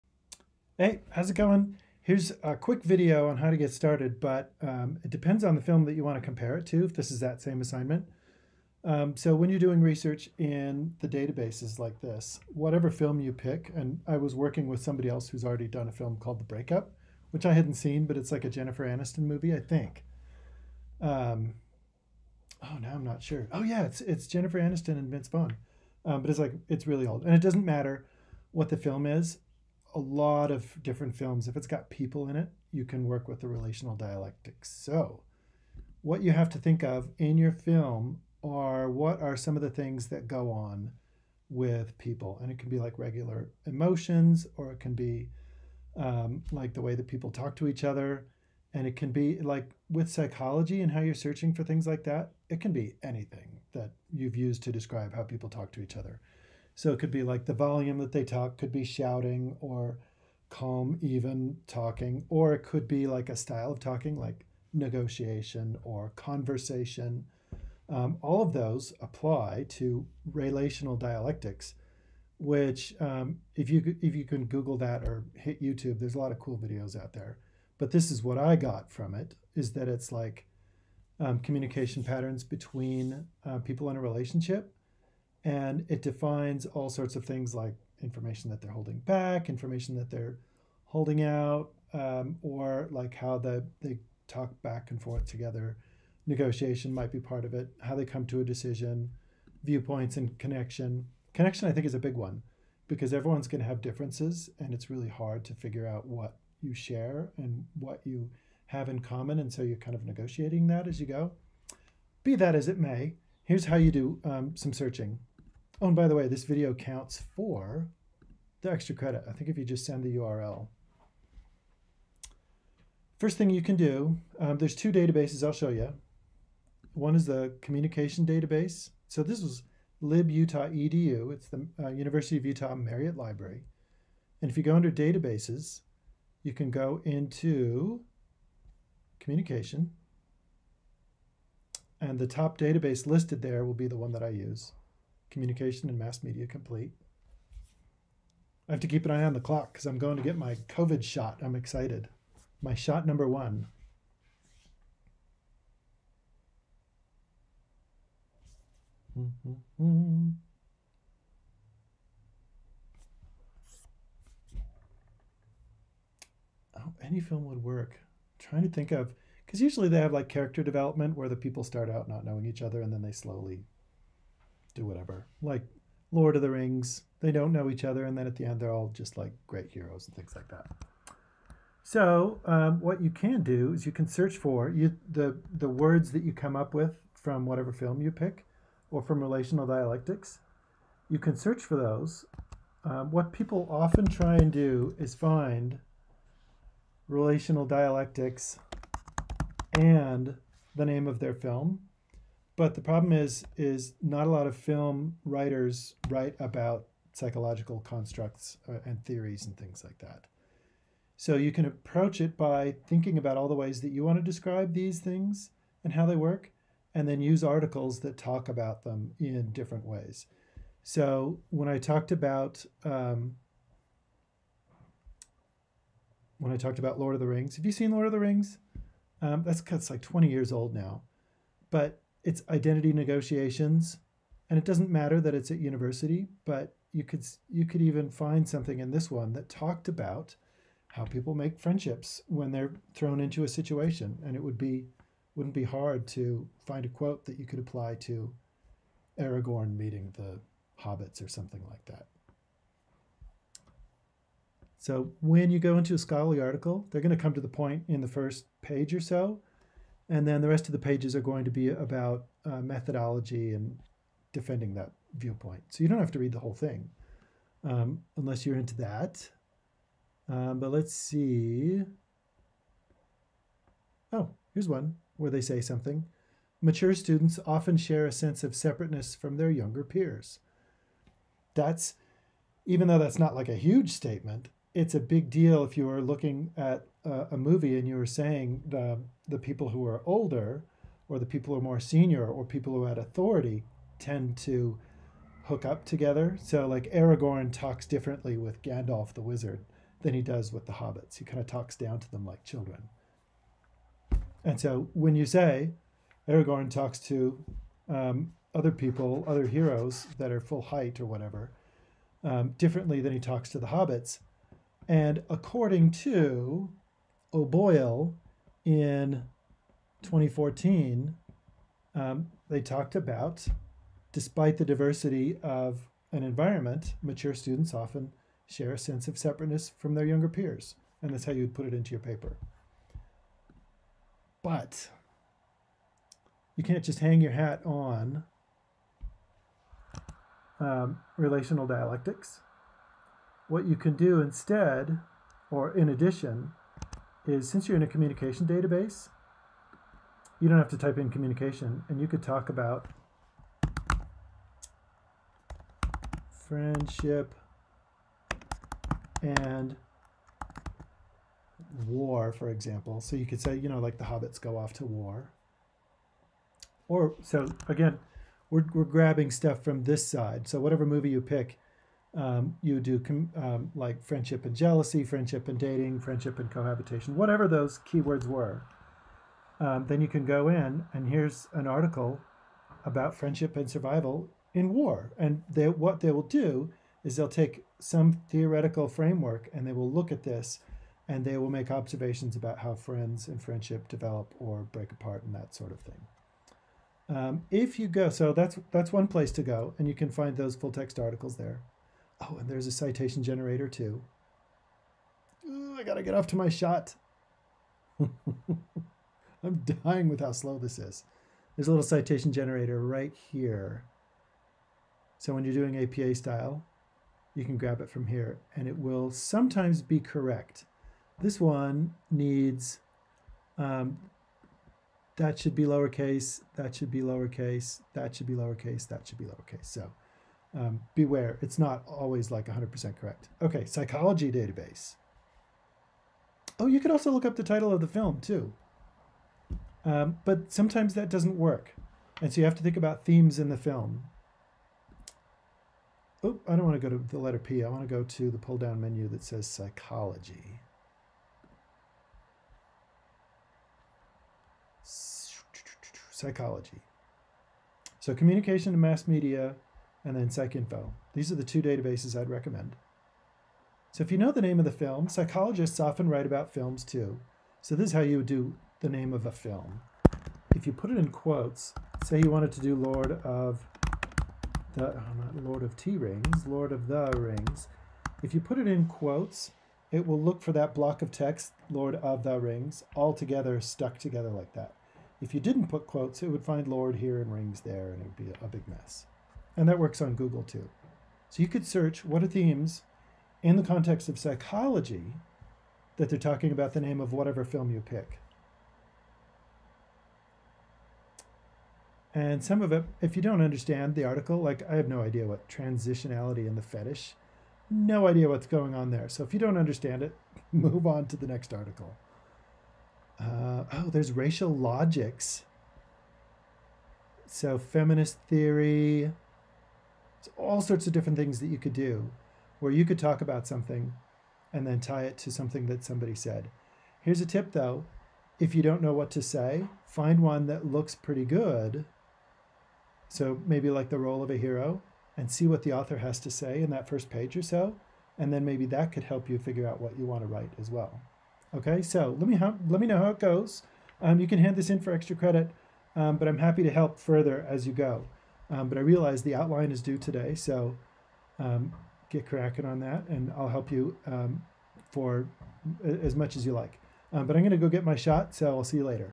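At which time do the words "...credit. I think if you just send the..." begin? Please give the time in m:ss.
1:58.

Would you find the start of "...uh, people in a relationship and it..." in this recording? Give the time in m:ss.
1:23.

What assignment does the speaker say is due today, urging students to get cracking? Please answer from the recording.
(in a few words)
The outline.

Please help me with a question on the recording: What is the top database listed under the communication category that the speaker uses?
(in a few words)
Communication and Mass Media Complete.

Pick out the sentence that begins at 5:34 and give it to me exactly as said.
But you can't just hang your hat on um, relational dialectics.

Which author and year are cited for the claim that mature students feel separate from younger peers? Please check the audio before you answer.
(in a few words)
O'Boyle, 2014.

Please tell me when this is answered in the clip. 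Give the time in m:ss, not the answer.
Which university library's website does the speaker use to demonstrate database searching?
2:11.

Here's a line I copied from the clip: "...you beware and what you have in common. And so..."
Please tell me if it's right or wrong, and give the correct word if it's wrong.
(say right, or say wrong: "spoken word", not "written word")
wrong: "share", not "beware".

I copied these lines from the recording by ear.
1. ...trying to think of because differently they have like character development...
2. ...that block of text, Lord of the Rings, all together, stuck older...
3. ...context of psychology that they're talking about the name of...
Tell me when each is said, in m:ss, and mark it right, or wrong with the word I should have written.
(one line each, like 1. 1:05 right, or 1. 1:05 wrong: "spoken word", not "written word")
1. 2:48 wrong: "usually", not "differently"
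2. 8:00 wrong: "together", not "older"
3. 8:13 right.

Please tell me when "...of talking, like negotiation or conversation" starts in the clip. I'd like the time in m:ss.
1:03.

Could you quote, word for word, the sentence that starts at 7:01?
This one needs, um, that should be lowercase, that should be lowercase, that should be lowercase, that should be lowercase.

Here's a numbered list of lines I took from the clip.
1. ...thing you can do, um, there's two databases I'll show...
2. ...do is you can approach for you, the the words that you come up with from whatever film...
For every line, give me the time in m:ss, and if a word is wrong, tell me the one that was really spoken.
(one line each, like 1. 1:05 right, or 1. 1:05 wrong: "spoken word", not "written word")
1. 2:03 right
2. 3:03 wrong: "search", not "approach".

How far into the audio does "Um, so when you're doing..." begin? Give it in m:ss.
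0:08.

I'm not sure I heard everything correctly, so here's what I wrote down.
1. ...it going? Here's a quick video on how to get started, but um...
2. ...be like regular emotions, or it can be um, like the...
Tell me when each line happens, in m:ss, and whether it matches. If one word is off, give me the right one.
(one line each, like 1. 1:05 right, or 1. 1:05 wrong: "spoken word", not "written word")
1. 0:01 right
2. 0:42 right.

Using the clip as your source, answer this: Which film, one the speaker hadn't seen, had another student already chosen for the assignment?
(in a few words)
The Breakup.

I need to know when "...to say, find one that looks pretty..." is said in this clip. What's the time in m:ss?
8:49.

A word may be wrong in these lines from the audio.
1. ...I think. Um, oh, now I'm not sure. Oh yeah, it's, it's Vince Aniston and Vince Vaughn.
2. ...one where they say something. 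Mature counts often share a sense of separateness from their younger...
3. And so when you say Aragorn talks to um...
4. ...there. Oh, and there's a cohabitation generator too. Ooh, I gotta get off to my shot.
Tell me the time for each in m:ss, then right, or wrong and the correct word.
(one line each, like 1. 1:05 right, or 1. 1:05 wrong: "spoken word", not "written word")
1. 0:19 wrong: "Jennifer", not "Vince"
2. 4:34 wrong: "students", not "counts"
3. 5:04 right
4. 6:41 wrong: "citation", not "cohabitation".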